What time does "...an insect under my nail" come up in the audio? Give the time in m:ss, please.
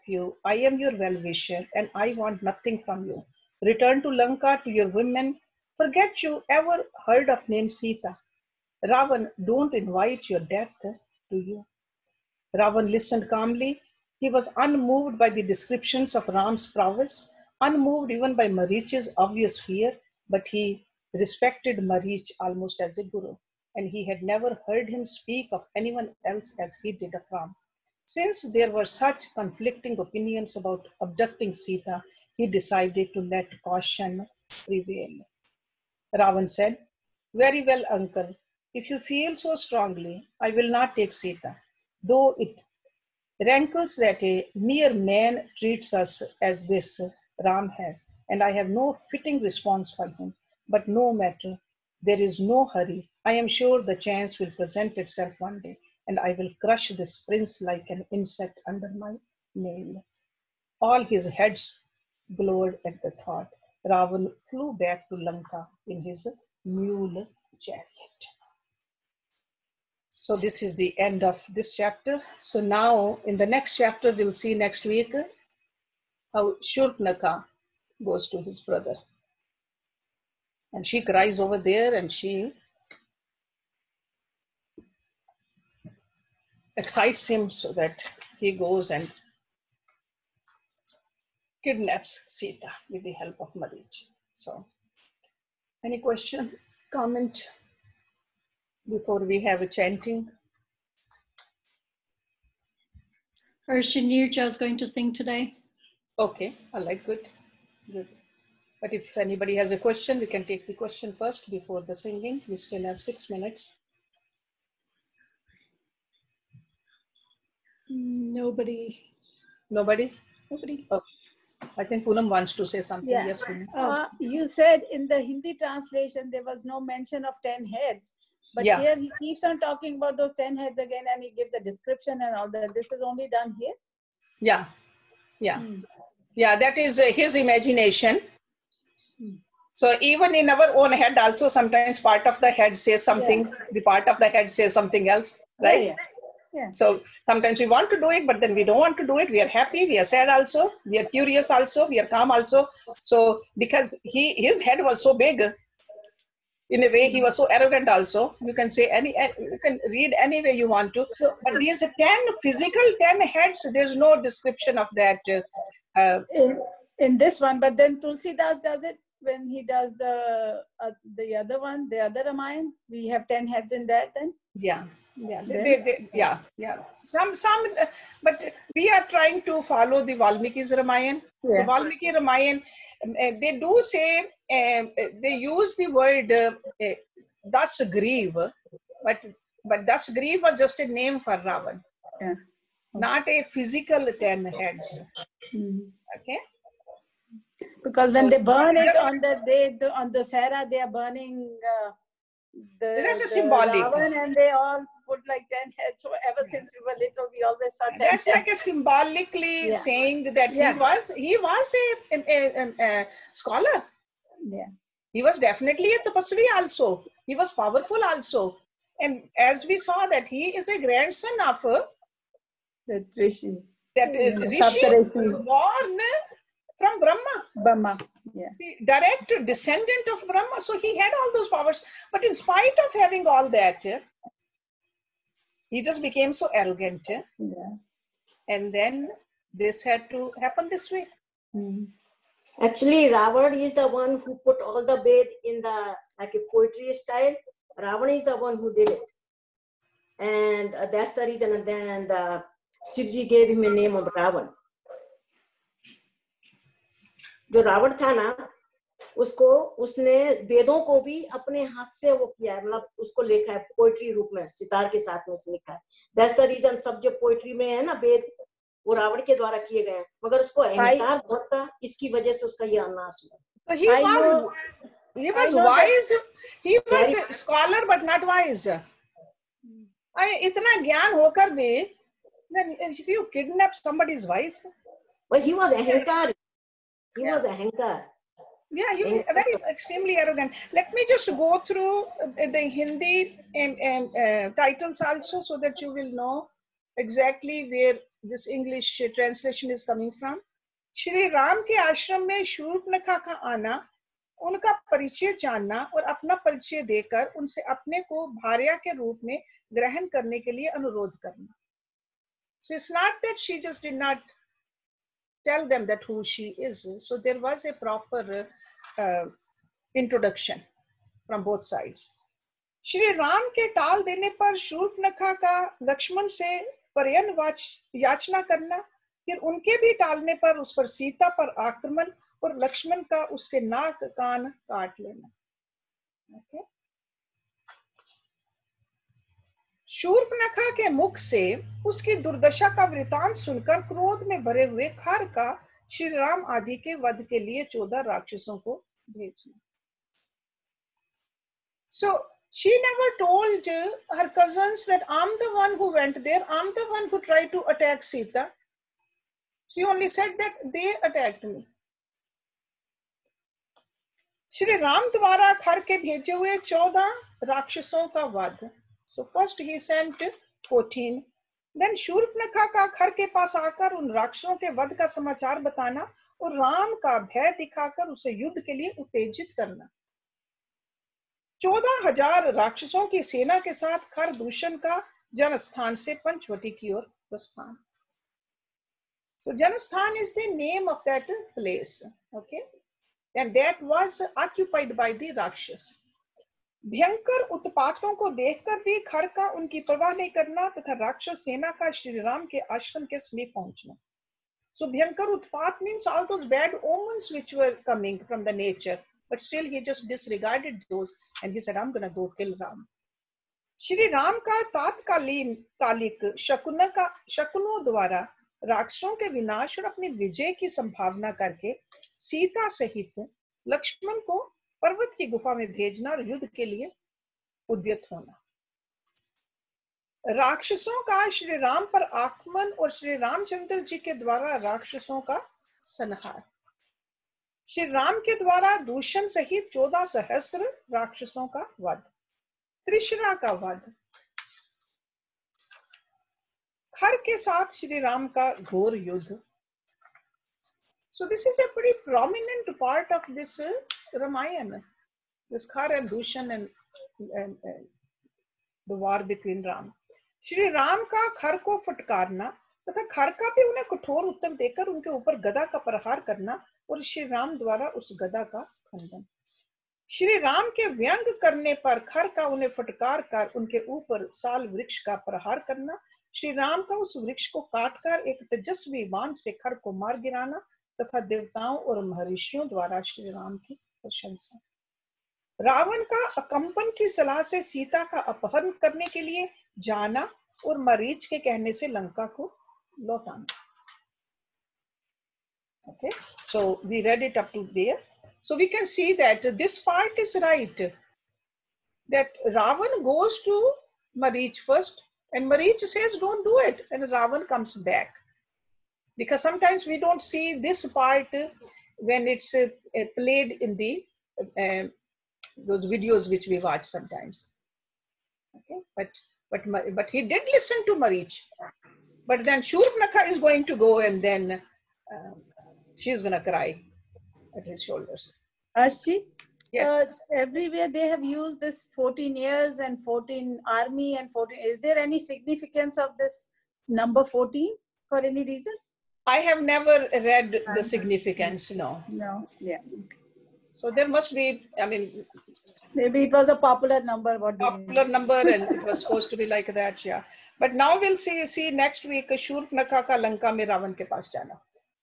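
0:57.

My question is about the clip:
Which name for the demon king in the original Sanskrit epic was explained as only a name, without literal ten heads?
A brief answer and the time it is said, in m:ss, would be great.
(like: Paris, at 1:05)
Dashagriva, at 3:09.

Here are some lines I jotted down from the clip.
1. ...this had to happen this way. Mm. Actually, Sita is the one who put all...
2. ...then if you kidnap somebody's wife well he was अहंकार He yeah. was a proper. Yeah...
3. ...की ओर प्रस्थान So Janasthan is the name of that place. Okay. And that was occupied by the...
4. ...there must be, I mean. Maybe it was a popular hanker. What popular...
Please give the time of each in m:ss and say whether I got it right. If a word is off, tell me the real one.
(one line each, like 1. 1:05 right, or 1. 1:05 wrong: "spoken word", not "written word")
1. 3:59 wrong: "Ravan", not "Sita"
2. 4:42 wrong: "hanker", not "proper"
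3. 6:26 right
4. 9:03 wrong: "number", not "hanker".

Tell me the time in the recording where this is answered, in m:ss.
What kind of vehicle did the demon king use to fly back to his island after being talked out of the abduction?
1:06.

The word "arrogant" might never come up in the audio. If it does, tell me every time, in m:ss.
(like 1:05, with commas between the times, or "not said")
2:37, 3:56, 4:50.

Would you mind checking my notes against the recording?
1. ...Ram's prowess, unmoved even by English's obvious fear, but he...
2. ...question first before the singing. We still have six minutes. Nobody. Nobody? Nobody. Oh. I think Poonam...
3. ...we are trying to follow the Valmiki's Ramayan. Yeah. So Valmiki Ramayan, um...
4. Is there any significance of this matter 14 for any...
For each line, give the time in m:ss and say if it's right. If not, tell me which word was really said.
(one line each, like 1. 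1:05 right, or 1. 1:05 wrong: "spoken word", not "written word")
1. 0:16 wrong: "Marich", not "English"
2. 1:50 right
3. 2:58 right
4. 8:54 wrong: "number", not "matter".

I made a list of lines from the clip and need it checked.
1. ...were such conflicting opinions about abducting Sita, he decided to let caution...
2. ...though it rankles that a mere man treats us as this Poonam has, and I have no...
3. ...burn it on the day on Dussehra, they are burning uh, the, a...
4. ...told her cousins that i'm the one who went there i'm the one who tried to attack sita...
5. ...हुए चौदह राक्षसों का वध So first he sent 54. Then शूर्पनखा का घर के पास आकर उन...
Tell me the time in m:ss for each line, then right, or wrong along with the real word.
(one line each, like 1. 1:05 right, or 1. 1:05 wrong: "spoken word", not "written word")
1. 0:28 right
2. 0:42 wrong: "Ram", not "Poonam"
3. 3:18 right
4. 5:53 right
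5. 6:06 wrong: "14", not "54".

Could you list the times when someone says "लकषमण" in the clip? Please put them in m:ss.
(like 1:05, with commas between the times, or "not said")
5:25, 5:32, 7:03.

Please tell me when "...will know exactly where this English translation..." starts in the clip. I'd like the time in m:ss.
4:55.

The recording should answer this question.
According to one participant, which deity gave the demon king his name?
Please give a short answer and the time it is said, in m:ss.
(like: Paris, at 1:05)
Shivji, at 4:12.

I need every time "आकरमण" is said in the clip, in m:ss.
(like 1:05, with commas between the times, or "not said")
5:31, 7:12.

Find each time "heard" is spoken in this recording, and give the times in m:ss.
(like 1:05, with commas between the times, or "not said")
0:07, 0:24.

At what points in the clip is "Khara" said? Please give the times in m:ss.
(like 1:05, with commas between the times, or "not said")
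7:35.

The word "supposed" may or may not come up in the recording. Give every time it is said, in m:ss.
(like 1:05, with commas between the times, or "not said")
9:08.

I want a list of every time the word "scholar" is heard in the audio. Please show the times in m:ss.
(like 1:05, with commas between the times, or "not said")
3:33, 4:37.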